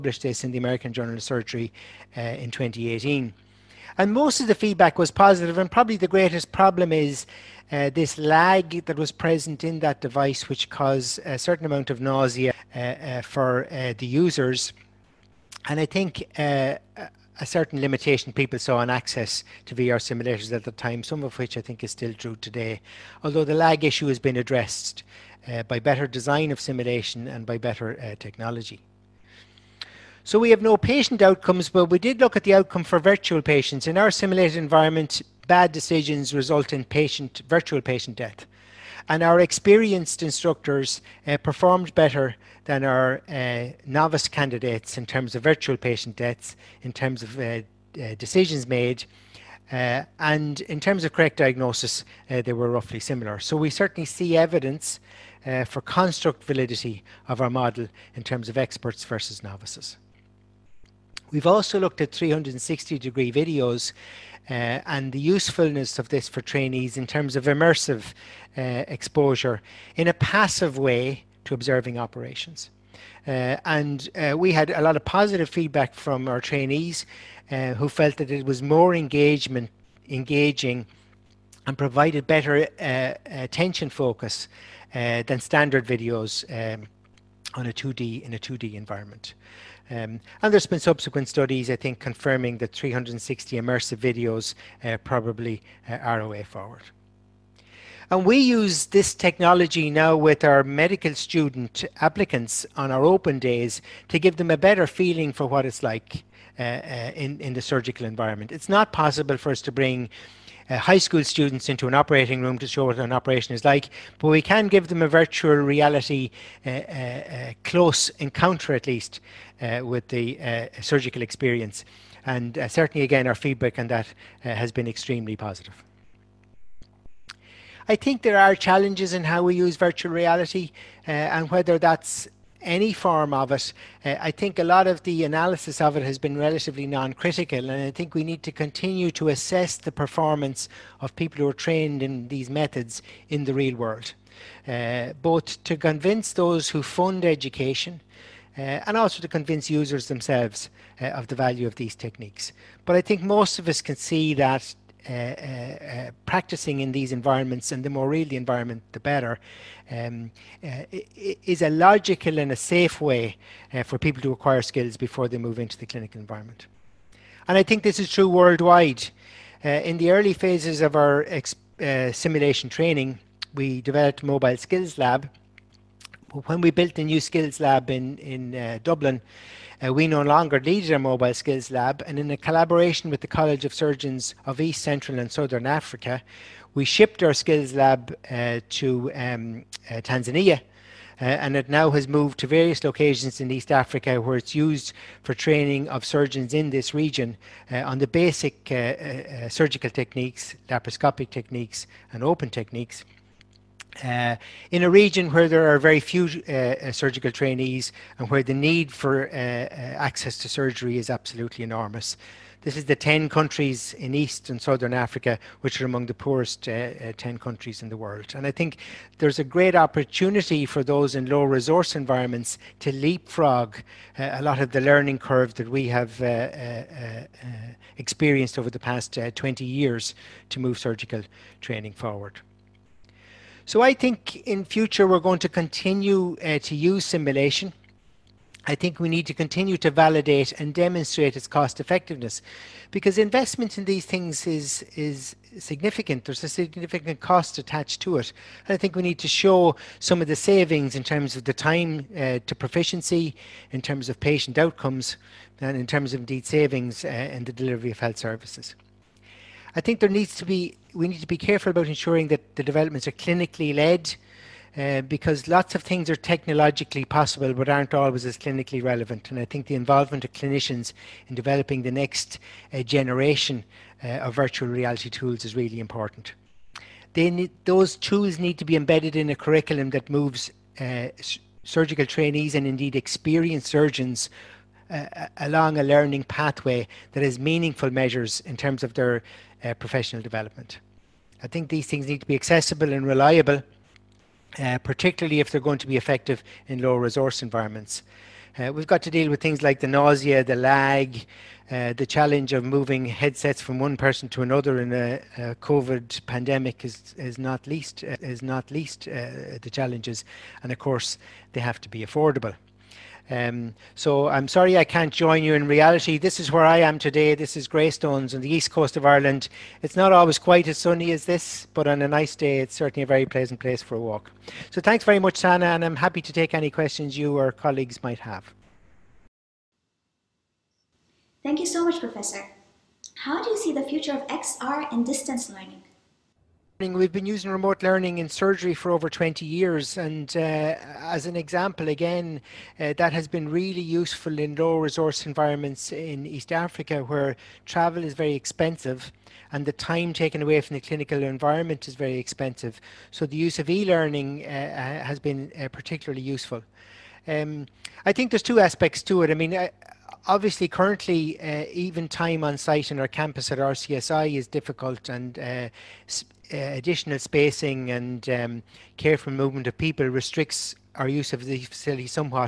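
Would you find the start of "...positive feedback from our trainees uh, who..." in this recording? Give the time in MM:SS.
01:15.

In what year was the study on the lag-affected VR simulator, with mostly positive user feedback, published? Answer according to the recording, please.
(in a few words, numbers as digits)
2018.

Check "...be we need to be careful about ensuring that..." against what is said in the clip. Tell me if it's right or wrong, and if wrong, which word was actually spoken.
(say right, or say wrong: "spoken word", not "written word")
right.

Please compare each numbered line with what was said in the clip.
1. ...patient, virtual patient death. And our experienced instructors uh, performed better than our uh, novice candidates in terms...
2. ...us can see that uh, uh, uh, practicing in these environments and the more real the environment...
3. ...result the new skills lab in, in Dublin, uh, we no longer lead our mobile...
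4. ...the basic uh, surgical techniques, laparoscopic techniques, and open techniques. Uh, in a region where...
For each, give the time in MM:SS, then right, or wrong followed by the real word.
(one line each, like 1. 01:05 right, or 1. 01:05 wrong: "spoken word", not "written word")
1. 00:36 right
2. 02:33 right
3. 02:56 wrong: "built", not "result"
4. 03:17 right.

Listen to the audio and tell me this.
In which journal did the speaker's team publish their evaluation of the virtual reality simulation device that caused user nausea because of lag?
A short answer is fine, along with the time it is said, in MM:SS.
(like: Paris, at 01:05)
American Journal of Surgery, at 00:00.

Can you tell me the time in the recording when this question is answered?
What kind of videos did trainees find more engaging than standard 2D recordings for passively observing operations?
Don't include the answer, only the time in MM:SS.
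01:02.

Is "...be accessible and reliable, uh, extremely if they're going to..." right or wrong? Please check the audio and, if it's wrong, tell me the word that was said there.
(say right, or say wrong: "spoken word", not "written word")
wrong: "particularly", not "extremely".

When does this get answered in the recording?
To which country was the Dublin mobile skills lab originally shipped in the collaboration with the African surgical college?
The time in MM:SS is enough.
03:09.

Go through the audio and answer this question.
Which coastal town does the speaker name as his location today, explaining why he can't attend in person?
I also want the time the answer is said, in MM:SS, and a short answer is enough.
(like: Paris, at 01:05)
Greystones, at 05:17.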